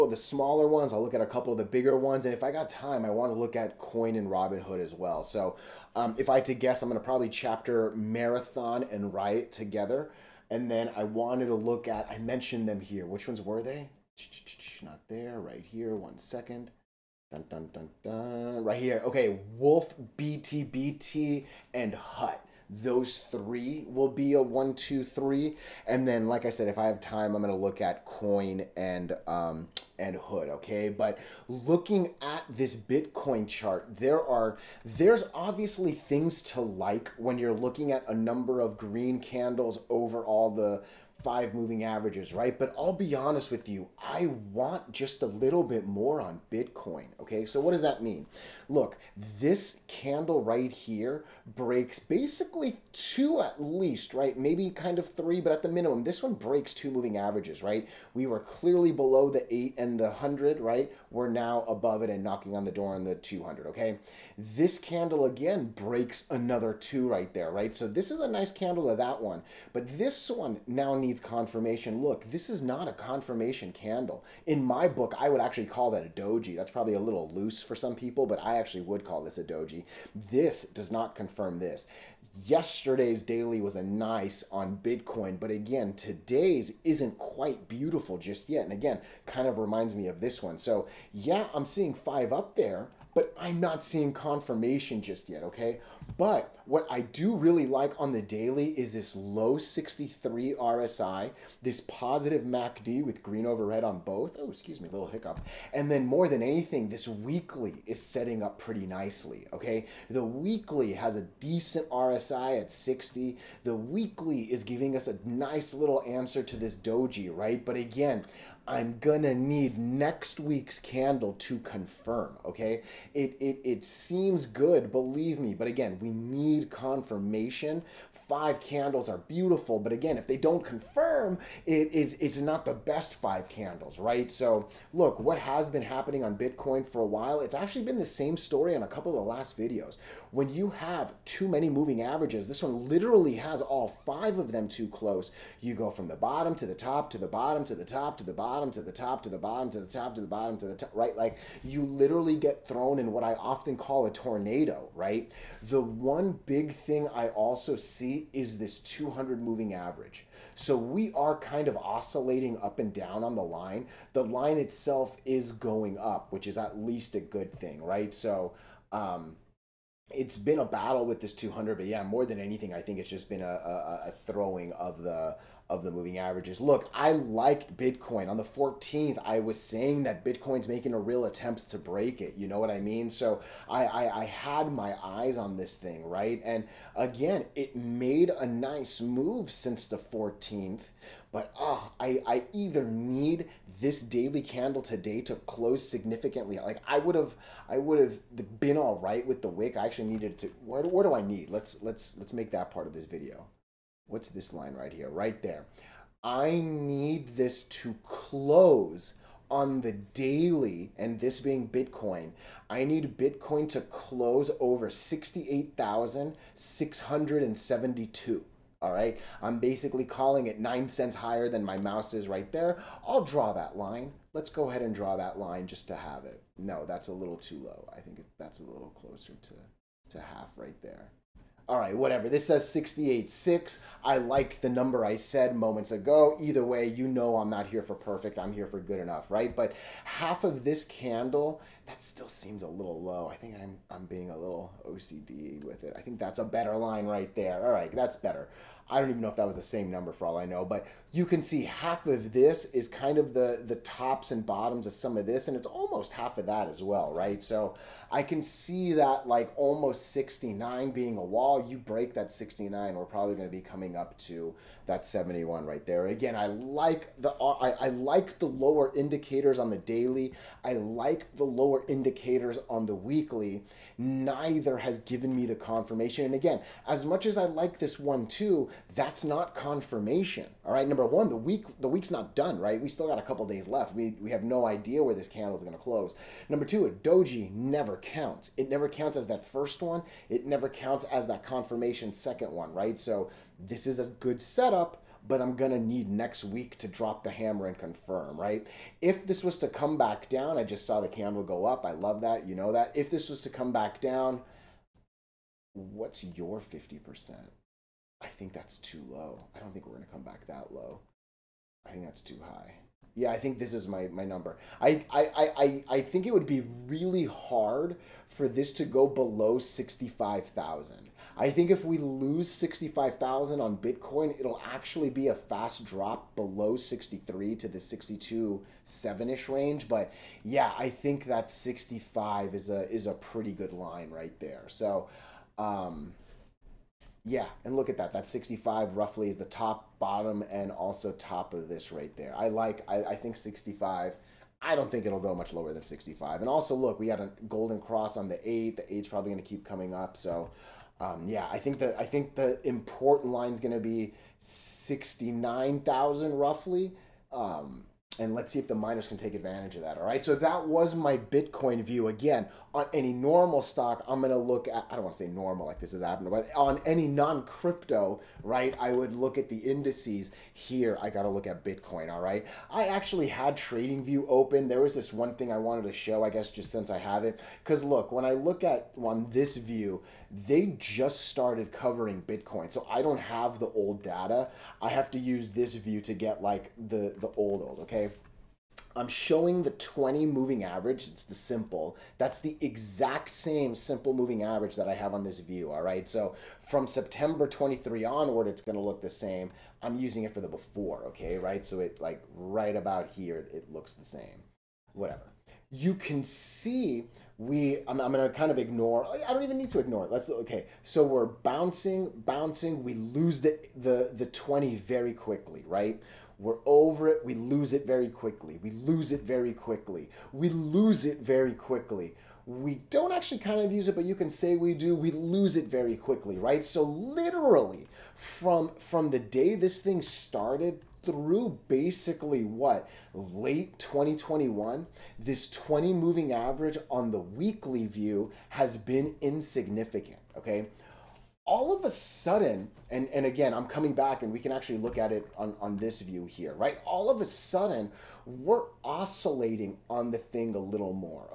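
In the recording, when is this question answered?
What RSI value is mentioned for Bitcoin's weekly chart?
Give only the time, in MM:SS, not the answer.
01:52.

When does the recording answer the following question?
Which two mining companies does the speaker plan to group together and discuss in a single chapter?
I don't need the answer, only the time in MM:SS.
00:07.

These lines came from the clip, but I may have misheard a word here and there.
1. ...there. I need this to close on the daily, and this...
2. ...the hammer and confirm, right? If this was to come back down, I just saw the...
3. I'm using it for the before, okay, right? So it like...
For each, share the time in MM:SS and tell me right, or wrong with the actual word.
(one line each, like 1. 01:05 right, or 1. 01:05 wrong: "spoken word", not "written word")
1. 03:25 right
2. 04:57 right
3. 06:39 right.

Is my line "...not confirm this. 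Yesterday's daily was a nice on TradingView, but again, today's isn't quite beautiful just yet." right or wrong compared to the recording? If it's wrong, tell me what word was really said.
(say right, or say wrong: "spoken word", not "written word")
wrong: "Bitcoin", not "TradingView".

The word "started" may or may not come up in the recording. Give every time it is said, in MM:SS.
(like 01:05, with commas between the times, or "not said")
06:21, 07:10.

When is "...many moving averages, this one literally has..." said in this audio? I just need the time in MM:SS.
02:21.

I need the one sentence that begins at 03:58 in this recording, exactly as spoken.
I'm here for good enough, right?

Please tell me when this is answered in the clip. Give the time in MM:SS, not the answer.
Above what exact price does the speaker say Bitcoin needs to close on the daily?
03:34.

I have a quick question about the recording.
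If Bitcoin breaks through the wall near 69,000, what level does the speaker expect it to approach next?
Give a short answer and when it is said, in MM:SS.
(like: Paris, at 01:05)
71, at 04:25.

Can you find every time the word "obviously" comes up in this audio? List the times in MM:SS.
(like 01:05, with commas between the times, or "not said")
00:35.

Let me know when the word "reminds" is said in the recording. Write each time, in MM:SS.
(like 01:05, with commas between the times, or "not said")
01:29.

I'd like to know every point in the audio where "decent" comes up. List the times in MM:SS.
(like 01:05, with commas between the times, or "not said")
01:51.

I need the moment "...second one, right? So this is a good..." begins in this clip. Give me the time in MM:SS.
04:52.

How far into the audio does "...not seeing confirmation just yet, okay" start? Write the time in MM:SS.
01:33.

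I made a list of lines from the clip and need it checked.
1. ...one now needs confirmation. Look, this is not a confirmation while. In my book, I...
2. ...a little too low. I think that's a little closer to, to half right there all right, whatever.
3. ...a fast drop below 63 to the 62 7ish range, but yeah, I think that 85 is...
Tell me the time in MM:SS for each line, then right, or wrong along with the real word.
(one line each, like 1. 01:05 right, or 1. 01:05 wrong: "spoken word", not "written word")
1. 01:10 wrong: "candle", not "while"
2. 03:47 right
3. 05:25 wrong: "65", not "85".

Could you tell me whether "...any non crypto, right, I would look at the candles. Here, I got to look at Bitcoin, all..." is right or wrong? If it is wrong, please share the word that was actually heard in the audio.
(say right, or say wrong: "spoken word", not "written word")
wrong: "indices", not "candles".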